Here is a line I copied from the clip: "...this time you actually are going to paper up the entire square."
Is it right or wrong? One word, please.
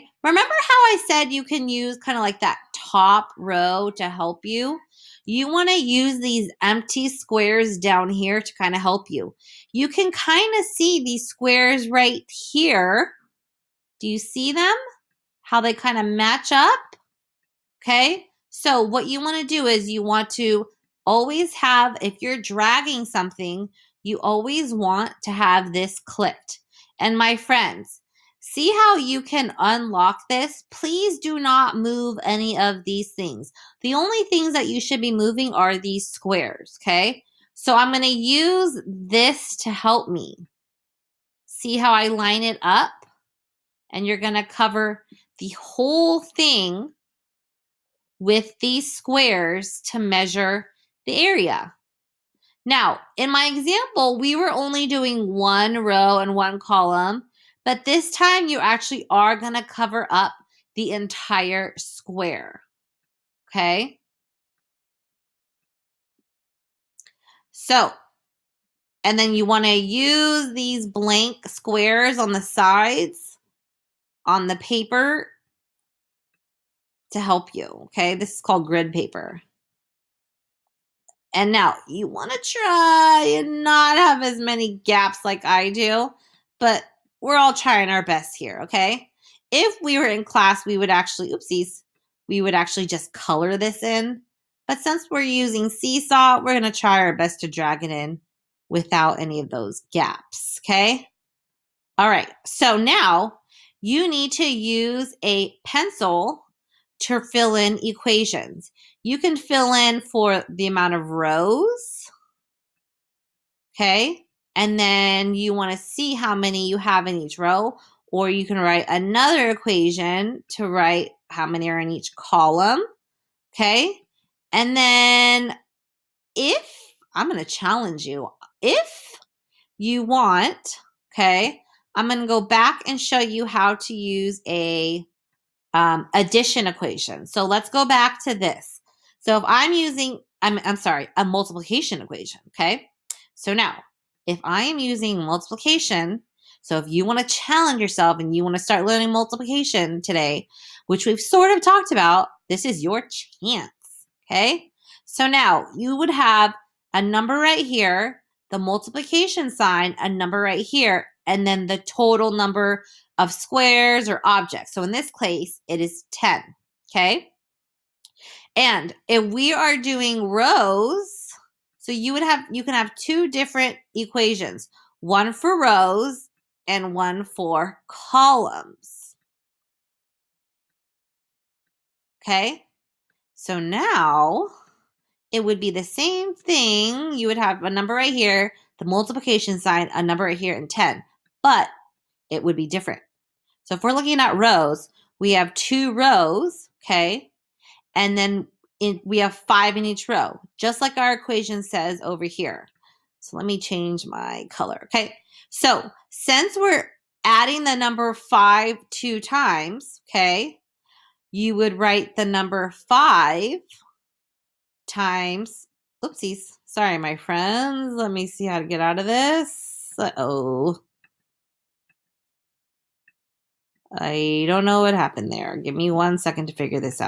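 wrong.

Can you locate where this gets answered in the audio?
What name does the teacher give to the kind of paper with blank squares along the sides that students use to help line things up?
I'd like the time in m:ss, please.
1:18.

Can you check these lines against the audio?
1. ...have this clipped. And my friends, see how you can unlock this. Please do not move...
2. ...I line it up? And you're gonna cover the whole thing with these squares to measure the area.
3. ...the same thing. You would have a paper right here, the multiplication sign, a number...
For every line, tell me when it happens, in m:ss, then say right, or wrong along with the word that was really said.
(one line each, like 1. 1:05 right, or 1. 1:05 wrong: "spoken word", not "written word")
1. 0:25 right
2. 0:41 right
3. 3:05 wrong: "number", not "paper".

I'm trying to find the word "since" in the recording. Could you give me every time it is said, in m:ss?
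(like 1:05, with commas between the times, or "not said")
1:34, 3:26.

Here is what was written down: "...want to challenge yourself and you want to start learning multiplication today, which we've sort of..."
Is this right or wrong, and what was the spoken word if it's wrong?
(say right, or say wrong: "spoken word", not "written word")
right.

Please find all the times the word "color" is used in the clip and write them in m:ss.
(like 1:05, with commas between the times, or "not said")
1:33, 3:24.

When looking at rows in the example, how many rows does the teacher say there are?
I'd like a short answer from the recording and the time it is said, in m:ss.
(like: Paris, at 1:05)
2, at 3:15.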